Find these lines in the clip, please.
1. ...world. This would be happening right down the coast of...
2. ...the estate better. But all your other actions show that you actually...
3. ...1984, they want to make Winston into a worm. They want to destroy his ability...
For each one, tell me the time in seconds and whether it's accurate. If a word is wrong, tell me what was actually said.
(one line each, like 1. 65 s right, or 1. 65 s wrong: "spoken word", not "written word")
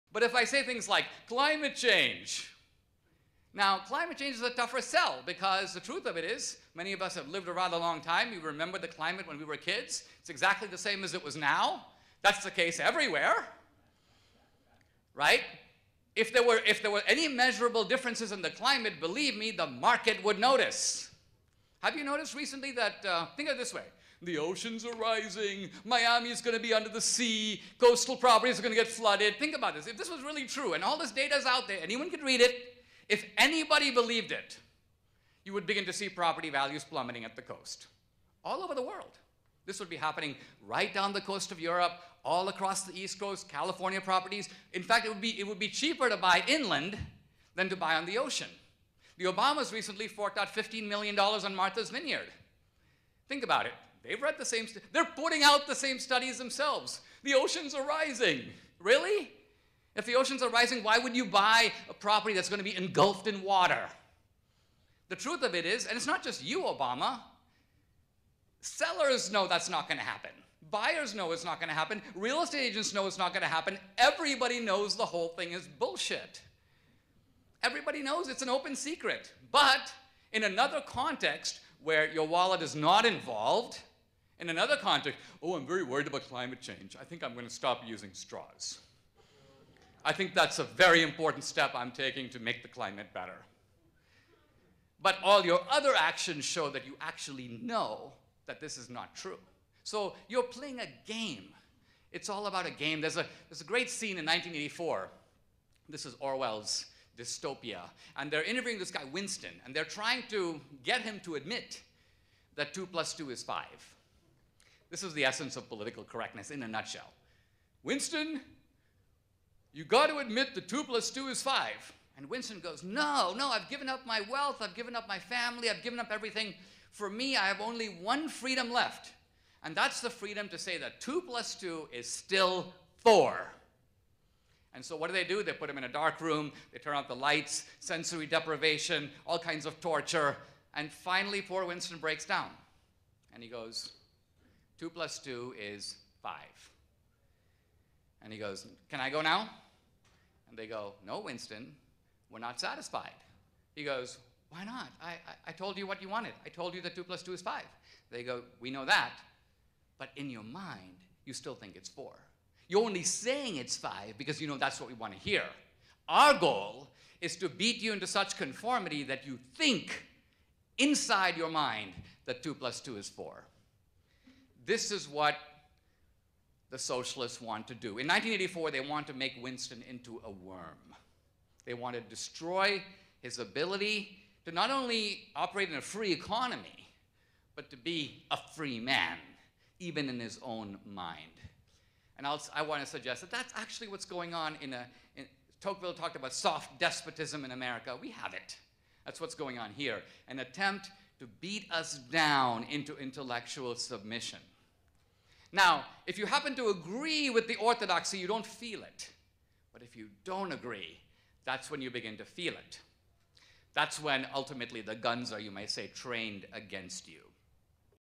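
1. 38 s right
2. 92 s wrong: "climate", not "estate"
3. 178 s right.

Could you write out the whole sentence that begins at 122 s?
And Winston goes, No, no, I've given up my wealth, I've given up my family, I've given up everything.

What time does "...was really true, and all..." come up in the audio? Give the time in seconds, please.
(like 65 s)
30 s.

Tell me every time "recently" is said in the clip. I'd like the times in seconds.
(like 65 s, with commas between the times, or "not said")
22 s, 49 s.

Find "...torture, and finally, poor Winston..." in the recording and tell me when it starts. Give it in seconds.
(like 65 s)
139 s.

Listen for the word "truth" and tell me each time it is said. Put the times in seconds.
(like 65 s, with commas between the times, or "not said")
5 s, 65 s.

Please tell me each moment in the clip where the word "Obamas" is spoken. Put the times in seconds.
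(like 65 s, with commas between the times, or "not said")
49 s, 66 s.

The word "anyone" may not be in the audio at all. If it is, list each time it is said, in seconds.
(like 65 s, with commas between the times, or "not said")
31 s.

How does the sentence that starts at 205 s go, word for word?
Now, if you happen to agree with the orthodoxy, you don't feel it.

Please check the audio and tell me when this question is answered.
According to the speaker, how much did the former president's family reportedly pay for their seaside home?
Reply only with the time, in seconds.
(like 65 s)
50 s.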